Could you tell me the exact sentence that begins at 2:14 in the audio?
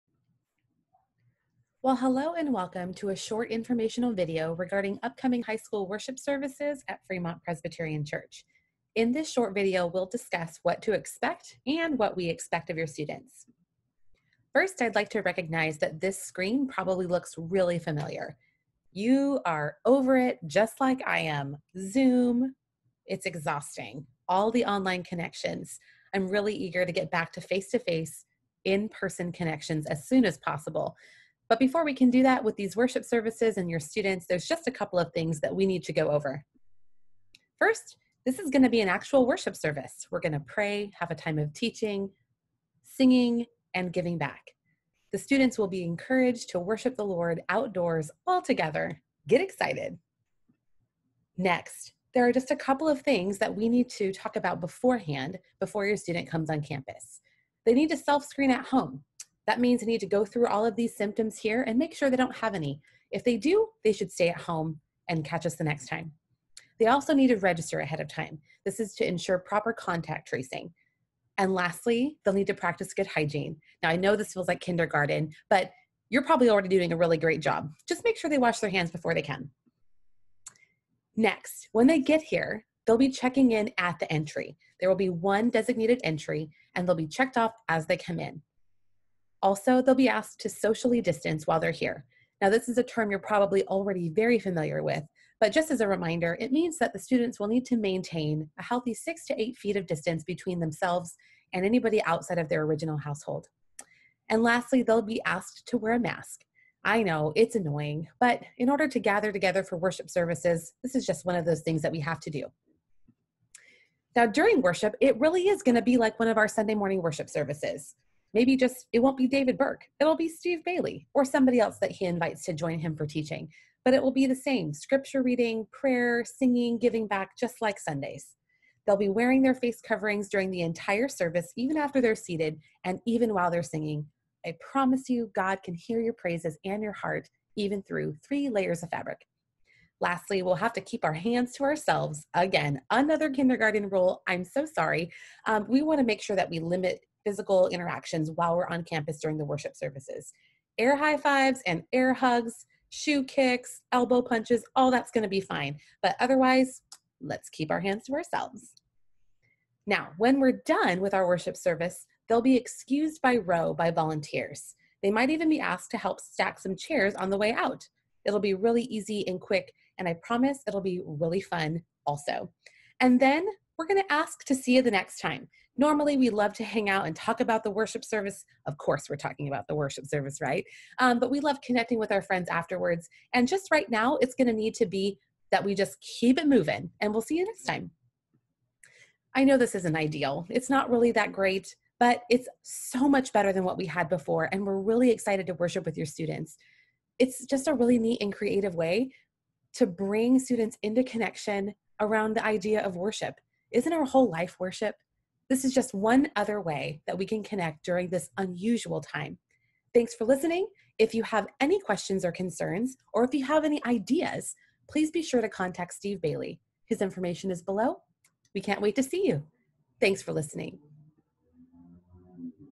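I promise you, God can hear your praises and your heart, even through three layers of fabric.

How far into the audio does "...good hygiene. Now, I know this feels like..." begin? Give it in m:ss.
1:12.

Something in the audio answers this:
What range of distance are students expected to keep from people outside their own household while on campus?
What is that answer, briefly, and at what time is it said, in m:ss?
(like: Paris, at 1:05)
6 to 8 feet, at 1:38.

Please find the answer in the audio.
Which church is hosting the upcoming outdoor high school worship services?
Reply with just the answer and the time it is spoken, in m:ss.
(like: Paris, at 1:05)
Fremont Presbyterian Church, at 0:07.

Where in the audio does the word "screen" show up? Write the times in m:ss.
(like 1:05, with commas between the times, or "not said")
0:16, 0:58.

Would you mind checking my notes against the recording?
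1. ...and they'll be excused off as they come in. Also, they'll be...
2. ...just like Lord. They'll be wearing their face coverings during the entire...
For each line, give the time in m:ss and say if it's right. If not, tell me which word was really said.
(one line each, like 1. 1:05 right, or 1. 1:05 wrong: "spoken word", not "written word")
1. 1:26 wrong: "checked", not "excused"
2. 2:07 wrong: "Sundays", not "Lord".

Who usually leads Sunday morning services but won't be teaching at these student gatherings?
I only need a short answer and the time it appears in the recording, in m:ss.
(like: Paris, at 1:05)
David Burke, at 1:59.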